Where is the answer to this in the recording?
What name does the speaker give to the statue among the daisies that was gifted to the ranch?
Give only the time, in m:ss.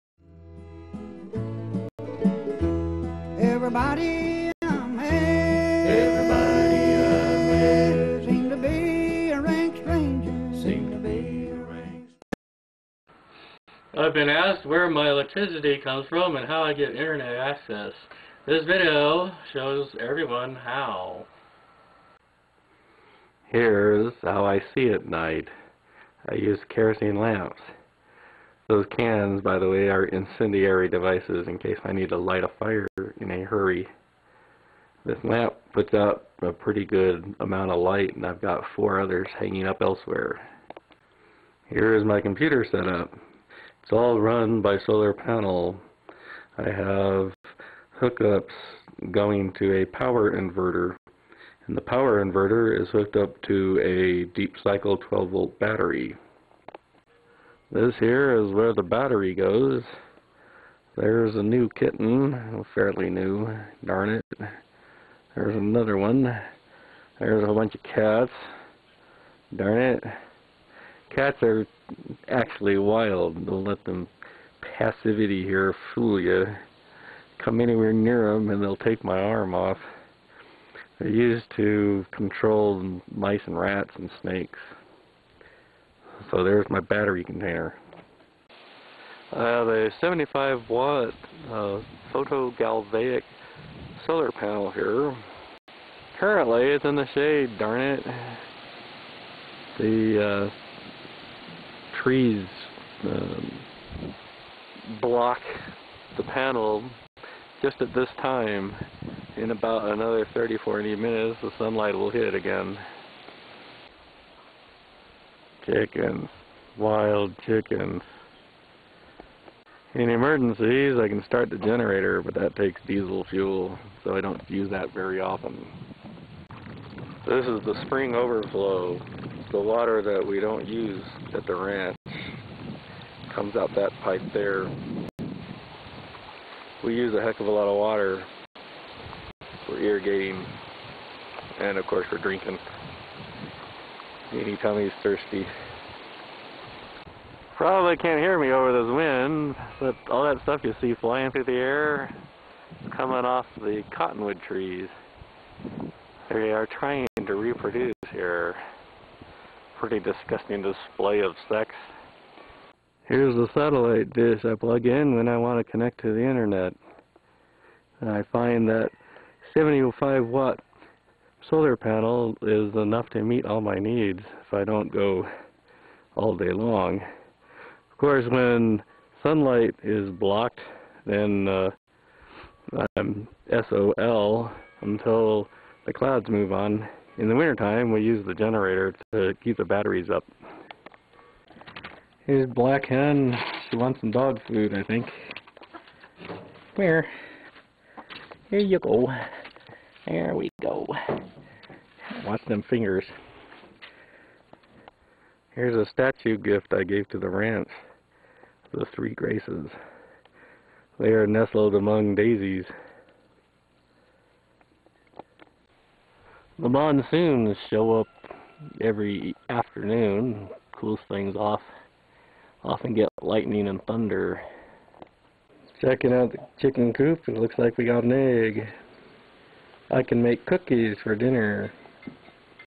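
3:28.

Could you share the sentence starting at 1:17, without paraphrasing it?
Come anywhere near them and they'll take my arm off.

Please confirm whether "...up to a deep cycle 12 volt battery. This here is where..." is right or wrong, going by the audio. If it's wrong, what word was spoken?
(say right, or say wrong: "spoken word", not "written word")
right.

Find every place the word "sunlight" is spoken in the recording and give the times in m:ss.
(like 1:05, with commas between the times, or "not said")
1:51, 2:59.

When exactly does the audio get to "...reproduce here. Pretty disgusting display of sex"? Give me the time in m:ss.
2:37.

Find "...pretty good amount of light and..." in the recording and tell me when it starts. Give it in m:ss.
0:36.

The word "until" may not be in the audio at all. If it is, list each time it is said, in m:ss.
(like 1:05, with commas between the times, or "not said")
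3:04.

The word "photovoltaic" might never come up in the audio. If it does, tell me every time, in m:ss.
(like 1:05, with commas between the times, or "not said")
1:32.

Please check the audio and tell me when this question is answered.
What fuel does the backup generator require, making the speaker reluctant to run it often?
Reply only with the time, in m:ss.
2:02.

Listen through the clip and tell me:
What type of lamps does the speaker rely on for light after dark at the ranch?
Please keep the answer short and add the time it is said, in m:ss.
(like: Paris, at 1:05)
kerosene lamps, at 0:26.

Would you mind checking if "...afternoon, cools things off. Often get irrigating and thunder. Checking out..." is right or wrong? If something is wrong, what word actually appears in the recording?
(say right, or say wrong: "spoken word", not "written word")
wrong: "lightning", not "irrigating".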